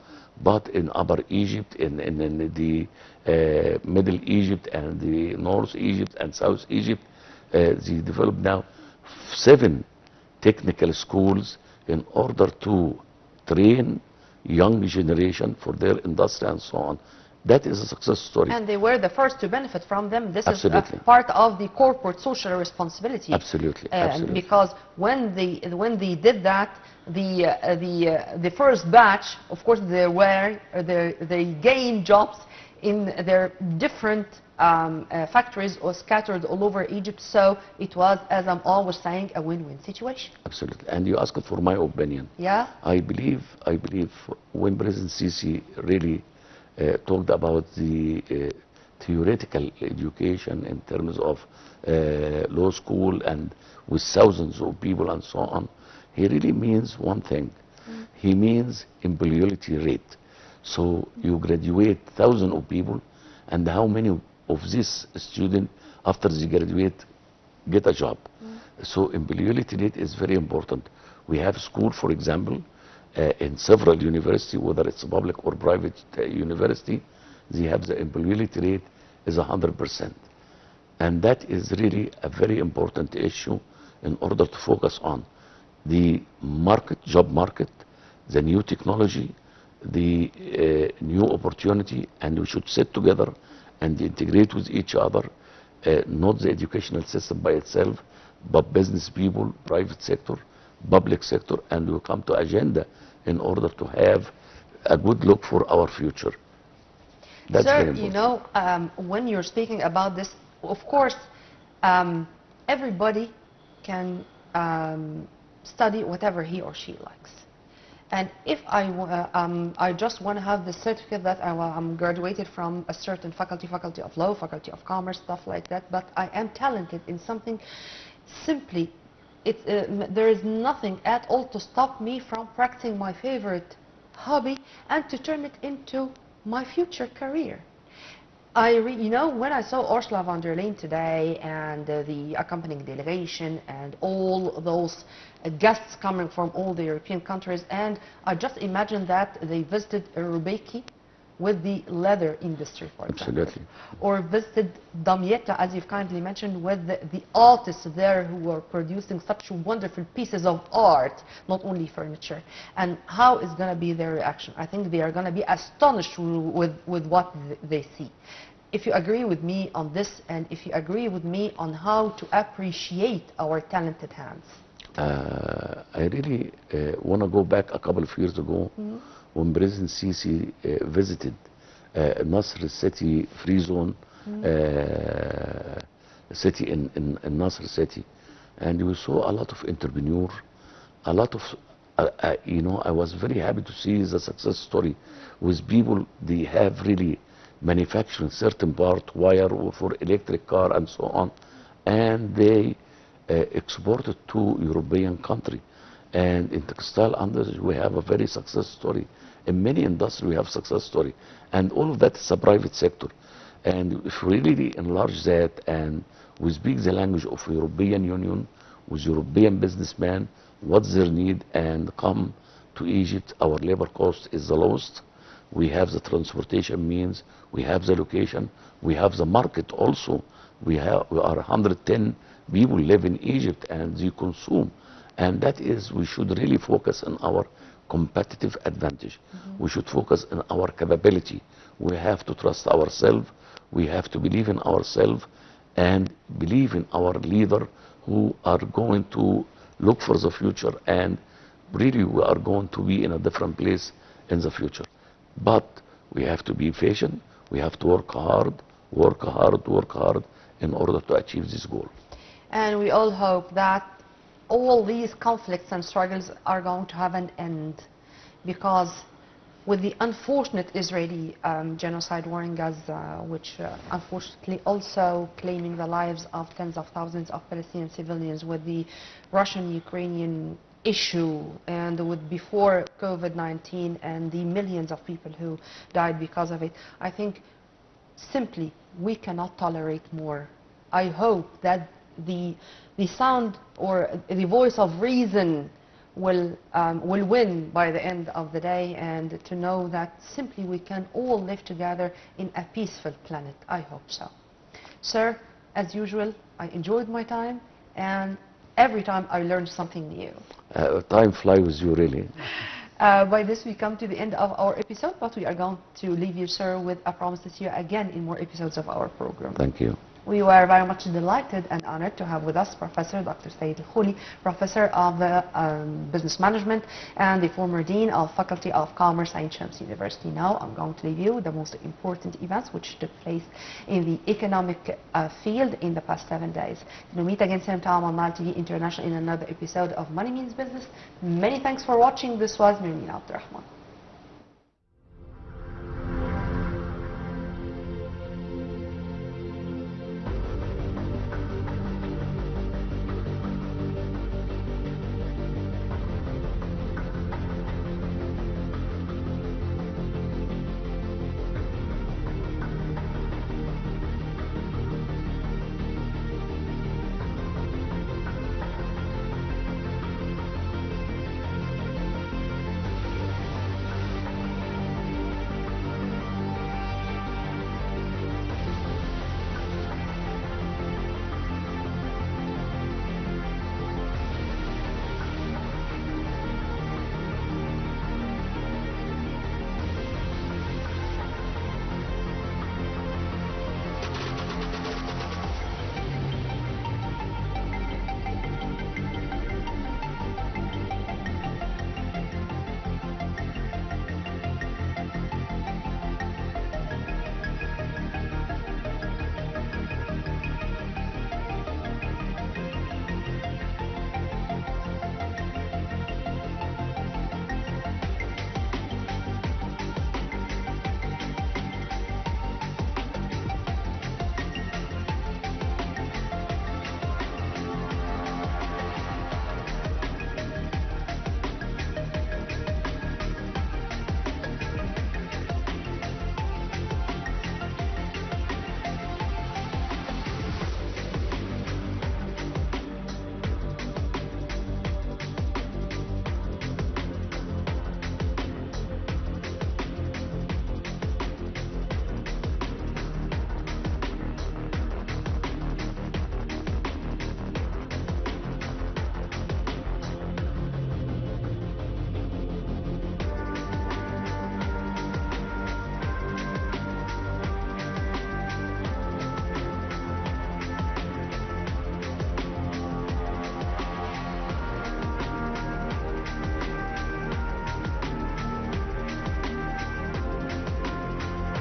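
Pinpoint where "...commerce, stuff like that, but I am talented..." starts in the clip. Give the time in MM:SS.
02:04.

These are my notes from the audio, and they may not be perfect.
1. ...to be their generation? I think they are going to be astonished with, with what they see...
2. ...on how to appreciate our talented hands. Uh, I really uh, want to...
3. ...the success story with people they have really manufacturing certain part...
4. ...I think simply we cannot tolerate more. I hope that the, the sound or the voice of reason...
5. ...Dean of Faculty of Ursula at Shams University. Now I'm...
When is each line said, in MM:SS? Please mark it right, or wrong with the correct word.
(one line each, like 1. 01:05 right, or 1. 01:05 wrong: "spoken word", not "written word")
1. 02:43 wrong: "reaction", not "generation"
2. 02:51 right
3. 03:14 right
4. 04:47 right
5. 05:27 wrong: "Commerce", not "Ursula".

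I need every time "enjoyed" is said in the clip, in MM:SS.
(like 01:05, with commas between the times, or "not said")
05:06.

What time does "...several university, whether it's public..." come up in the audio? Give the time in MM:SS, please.
01:13.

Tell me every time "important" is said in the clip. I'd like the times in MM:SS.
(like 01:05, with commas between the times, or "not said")
01:10, 01:22, 05:31.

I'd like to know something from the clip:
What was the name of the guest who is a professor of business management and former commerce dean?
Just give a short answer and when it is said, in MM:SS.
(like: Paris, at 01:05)
Said Al-Khouli, at 05:23.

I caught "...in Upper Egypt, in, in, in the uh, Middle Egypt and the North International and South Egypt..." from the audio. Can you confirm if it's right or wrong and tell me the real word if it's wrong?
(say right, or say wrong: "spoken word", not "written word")
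wrong: "Egypt", not "International".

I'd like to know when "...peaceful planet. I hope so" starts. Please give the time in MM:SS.
05:02.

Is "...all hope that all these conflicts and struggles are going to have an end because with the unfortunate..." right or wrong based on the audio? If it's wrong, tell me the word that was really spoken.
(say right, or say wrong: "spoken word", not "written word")
right.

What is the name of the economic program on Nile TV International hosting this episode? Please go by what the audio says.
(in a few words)
Money Means Business.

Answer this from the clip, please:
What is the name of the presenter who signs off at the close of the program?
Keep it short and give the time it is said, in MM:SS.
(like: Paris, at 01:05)
Mirmin Abdurrahman, at 05:42.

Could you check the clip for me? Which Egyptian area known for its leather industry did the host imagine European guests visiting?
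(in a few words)
Robbiki.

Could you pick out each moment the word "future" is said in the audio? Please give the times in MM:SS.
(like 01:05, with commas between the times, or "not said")
01:45, 02:16, 04:10, 04:14.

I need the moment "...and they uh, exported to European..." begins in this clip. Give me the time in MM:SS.
03:21.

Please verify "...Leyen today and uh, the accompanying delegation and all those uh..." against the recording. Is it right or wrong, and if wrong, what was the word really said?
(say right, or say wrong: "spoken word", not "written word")
right.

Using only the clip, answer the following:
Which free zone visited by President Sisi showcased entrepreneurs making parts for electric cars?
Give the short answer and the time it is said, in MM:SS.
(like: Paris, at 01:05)
Nasr City Free Zone, at 03:02.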